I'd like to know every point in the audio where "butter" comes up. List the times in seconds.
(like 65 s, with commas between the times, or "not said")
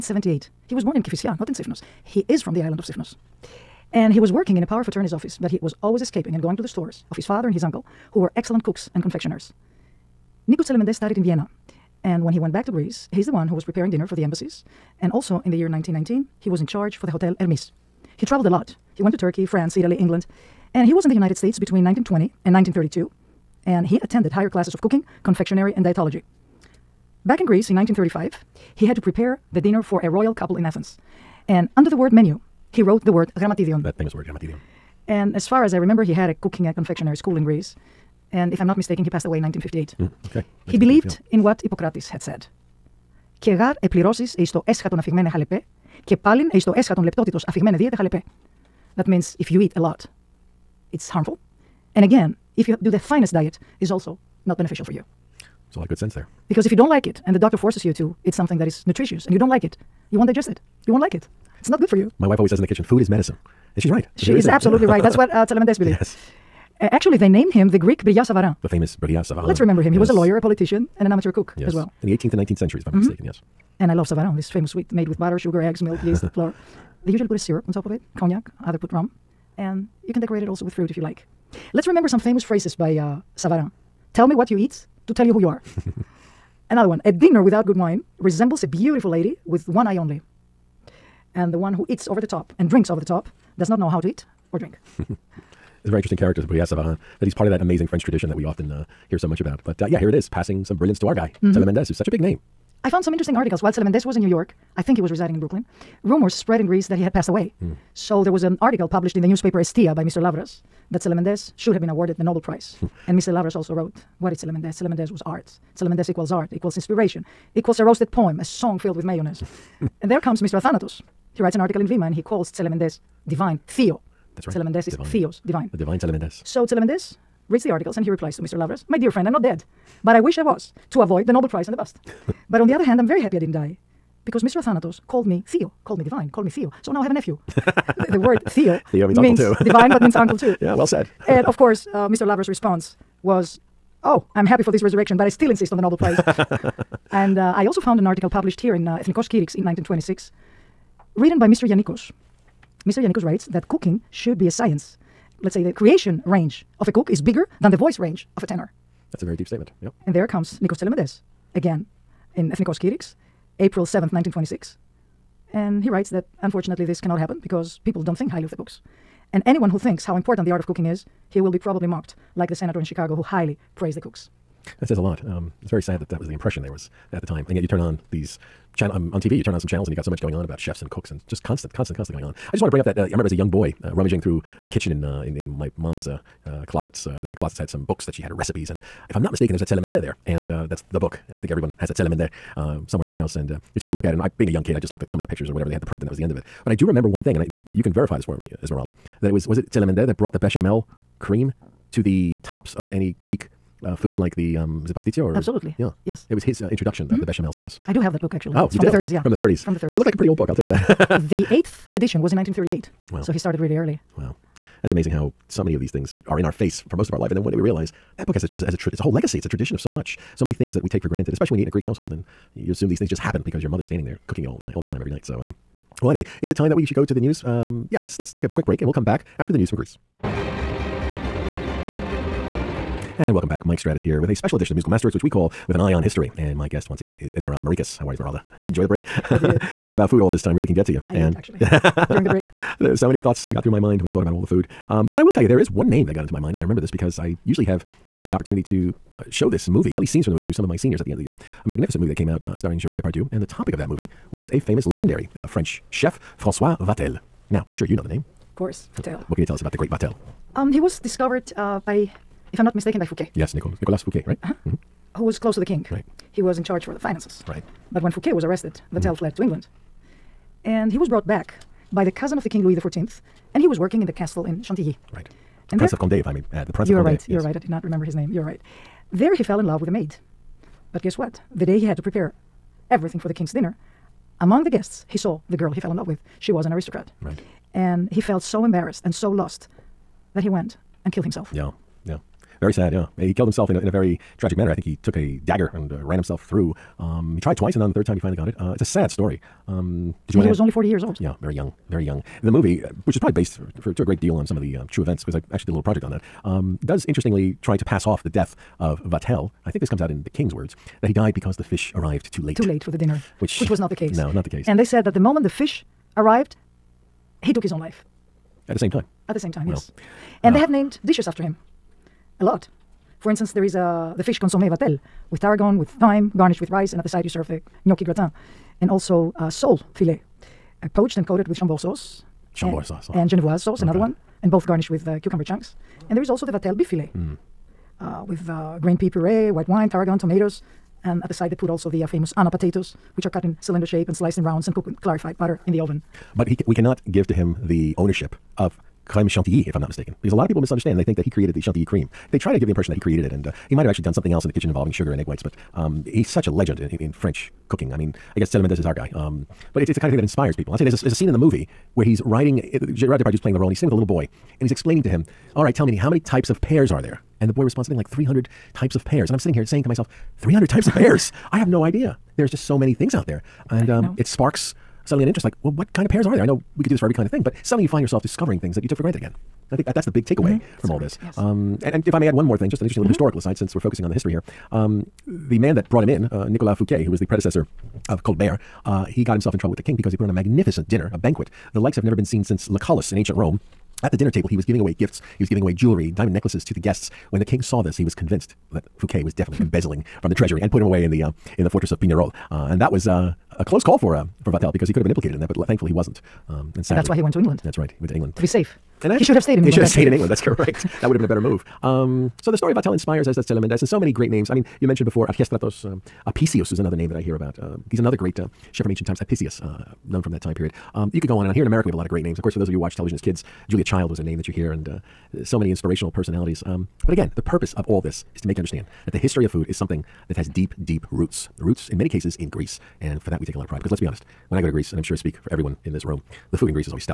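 75 s, 345 s.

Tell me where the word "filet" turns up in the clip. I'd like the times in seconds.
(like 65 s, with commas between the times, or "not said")
329 s, 336 s.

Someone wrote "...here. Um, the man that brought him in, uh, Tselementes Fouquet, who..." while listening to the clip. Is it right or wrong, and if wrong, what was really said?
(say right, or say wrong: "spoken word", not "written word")
wrong: "Nicolas", not "Tselementes".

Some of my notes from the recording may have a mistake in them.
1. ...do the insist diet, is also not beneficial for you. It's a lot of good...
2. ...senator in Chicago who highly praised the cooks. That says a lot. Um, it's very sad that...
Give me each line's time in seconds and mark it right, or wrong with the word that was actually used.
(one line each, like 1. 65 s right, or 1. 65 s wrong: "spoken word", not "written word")
1. 52 s wrong: "finest", not "insist"
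2. 172 s right.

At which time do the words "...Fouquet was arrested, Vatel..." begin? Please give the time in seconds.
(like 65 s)
268 s.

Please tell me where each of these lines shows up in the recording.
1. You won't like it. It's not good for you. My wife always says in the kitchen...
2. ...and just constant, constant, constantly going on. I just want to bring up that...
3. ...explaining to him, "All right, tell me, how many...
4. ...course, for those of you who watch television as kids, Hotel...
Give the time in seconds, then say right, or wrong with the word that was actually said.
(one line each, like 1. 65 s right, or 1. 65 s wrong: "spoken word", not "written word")
1. 60 s right
2. 181 s right
3. 364 s right
4. 422 s wrong: "Julia", not "Hotel".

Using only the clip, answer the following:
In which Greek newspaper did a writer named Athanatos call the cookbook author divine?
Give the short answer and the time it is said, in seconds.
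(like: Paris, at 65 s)
Vima, at 121 s.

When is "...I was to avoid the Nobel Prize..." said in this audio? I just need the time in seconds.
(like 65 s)
130 s.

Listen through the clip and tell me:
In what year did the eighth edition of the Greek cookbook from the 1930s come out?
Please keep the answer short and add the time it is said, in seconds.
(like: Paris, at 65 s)
1938, at 212 s.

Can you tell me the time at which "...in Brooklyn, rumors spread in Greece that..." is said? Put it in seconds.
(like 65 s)
105 s.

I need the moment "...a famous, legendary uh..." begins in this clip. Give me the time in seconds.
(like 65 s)
254 s.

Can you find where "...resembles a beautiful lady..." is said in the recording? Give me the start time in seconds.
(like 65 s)
88 s.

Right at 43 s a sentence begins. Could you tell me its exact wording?
Και γάρ επληρώσεις εις το έσχατον αφηγμένε χαλεπέ και πάλιν εις το έσχατον λεπτότητος αφηγμένε δίαιτε χαλεπέ.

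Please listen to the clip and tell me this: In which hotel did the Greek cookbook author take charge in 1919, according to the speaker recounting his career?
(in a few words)
Hotel Hermes.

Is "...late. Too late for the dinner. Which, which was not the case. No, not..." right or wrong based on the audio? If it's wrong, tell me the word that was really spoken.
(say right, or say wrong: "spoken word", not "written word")
right.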